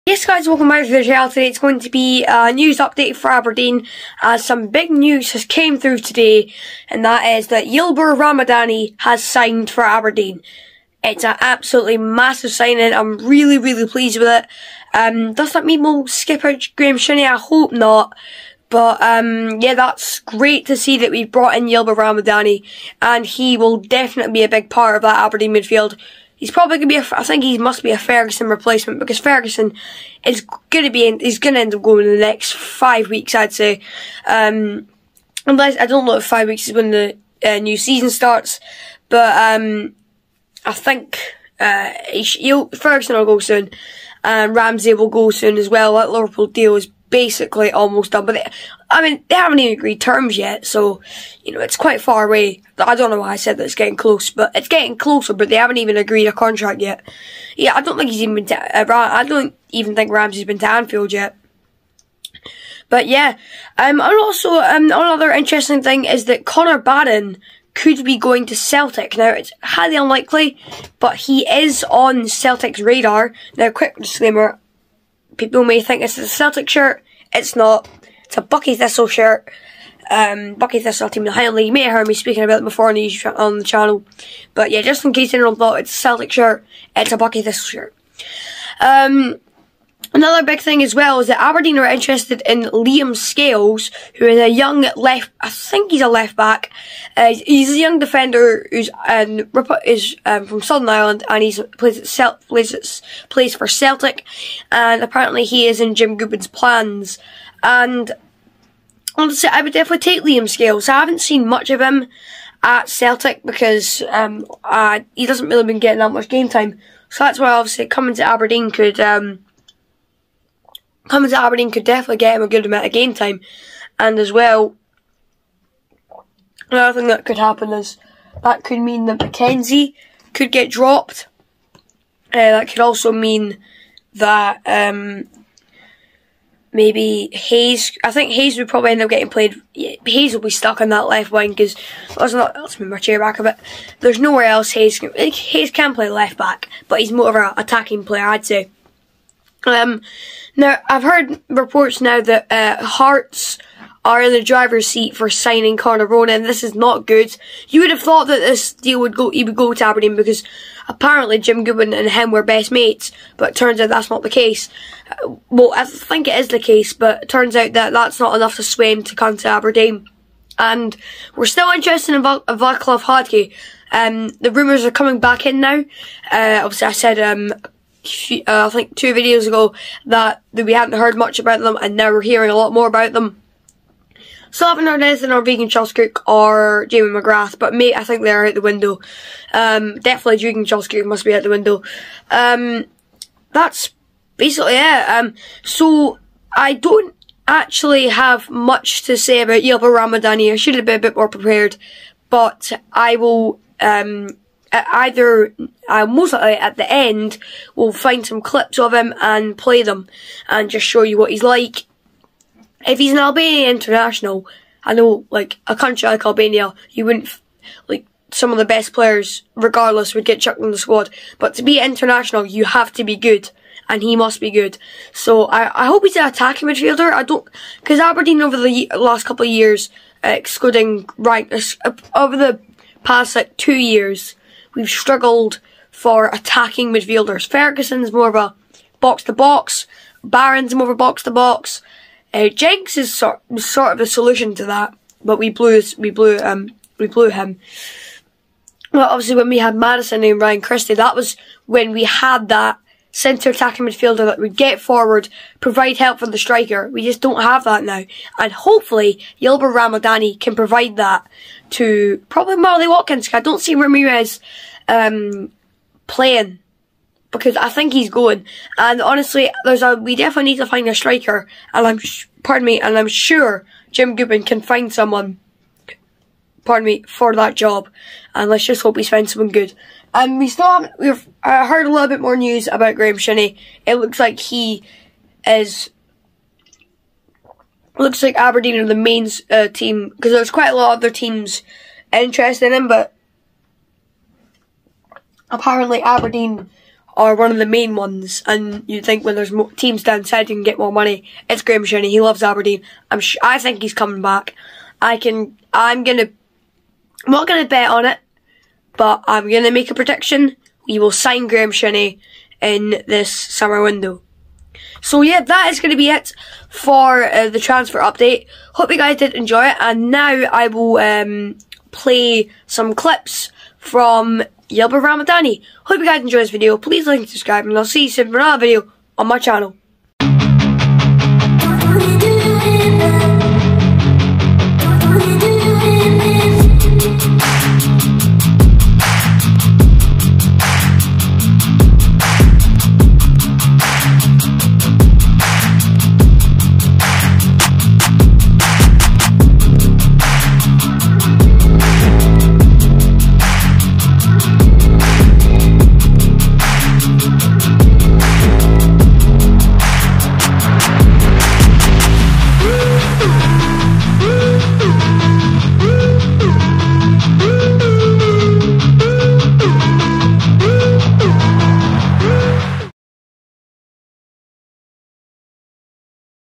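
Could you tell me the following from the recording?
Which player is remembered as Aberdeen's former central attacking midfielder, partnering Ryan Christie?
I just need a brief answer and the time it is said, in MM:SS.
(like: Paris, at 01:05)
Maddison, at 04:09.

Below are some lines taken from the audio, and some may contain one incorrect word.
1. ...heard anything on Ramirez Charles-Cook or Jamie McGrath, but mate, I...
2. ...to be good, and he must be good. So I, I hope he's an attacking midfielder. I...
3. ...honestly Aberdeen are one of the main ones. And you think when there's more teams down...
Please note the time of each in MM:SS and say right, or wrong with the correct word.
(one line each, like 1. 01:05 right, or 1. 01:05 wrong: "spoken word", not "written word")
1. 03:04 wrong: "Regan", not "Ramirez"
2. 03:42 right
3. 04:55 wrong: "apparently", not "honestly".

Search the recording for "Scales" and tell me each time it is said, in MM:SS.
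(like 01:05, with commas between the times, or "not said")
01:33, 01:50.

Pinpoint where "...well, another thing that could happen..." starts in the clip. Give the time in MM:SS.
02:04.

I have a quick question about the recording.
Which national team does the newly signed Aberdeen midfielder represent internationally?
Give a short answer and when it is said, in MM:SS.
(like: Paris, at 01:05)
Albania, at 03:33.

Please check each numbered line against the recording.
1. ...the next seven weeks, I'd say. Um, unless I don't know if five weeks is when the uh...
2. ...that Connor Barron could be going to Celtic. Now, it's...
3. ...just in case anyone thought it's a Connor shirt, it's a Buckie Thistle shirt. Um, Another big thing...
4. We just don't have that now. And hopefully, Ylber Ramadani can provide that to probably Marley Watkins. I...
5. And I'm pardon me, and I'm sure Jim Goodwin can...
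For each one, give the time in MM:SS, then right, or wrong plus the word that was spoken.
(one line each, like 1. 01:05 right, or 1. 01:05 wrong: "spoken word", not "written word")
1. 00:32 wrong: "five", not "seven"
2. 01:06 right
3. 01:24 wrong: "Celtic", not "Connor"
4. 04:16 right
5. 04:31 right.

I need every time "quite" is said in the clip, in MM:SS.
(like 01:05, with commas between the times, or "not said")
00:51, 04:50.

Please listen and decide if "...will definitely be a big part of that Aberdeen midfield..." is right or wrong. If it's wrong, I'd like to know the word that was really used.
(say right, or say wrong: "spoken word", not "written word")
right.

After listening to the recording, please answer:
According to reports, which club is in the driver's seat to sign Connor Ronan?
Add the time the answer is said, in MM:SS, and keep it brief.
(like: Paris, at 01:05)
Hearts, at 02:32.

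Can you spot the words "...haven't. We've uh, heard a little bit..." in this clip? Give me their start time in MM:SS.
04:40.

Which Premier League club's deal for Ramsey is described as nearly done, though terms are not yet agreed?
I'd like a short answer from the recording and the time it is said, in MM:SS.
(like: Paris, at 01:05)
Liverpool, at 00:46.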